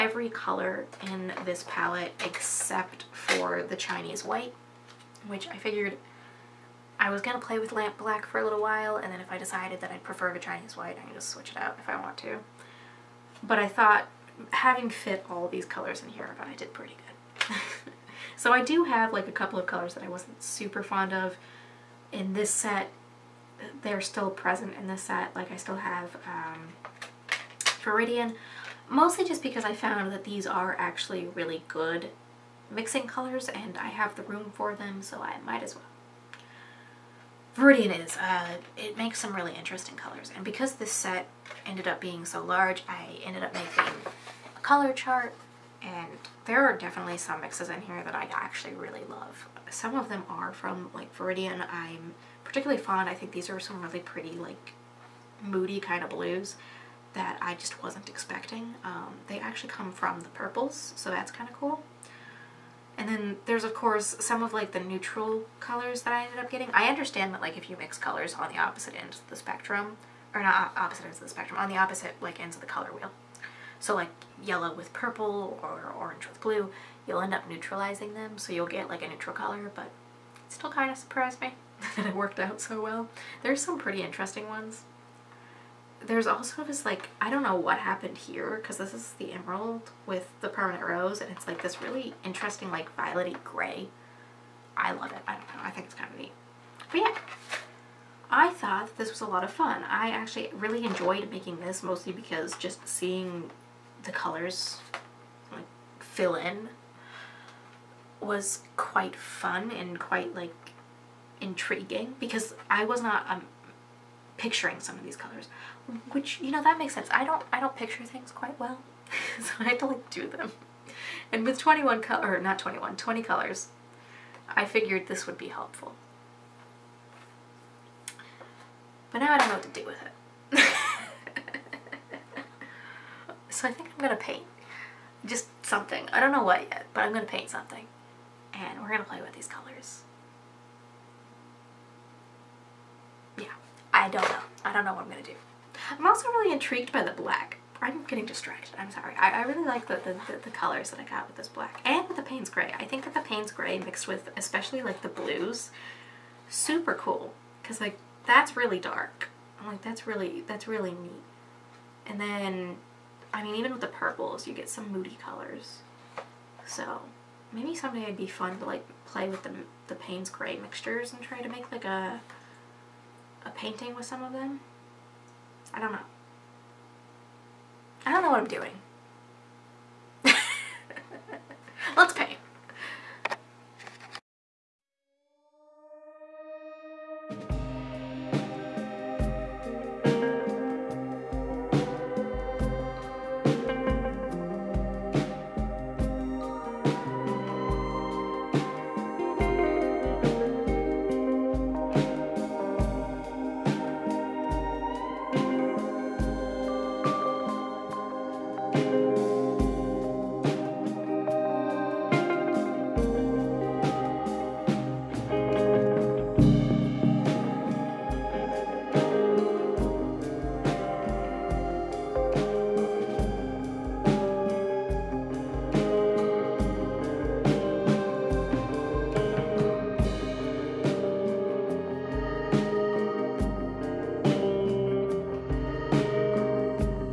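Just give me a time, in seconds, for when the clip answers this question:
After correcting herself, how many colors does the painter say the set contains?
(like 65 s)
122 s.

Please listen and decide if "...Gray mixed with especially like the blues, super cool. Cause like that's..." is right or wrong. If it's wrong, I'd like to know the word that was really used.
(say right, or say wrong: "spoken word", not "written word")
right.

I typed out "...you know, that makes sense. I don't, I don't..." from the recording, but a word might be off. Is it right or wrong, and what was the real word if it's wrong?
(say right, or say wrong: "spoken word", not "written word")
right.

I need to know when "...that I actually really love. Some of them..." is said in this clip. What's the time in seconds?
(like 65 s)
48 s.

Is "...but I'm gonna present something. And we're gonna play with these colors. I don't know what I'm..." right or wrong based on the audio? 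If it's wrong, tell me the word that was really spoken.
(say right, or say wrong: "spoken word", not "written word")
wrong: "paint", not "present".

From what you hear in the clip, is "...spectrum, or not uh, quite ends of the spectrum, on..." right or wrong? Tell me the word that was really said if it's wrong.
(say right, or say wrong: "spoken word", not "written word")
wrong: "opposite", not "quite".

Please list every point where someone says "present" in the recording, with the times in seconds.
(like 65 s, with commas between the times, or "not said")
24 s.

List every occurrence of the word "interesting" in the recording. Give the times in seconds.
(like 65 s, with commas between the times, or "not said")
39 s, 84 s, 92 s.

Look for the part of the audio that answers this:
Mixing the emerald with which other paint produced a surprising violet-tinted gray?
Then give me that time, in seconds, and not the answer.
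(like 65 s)
90 s.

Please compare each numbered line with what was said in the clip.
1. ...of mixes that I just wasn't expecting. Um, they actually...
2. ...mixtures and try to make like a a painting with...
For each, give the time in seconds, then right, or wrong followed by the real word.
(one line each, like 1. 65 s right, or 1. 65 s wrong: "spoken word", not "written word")
1. 56 s wrong: "blues", not "mixes"
2. 170 s right.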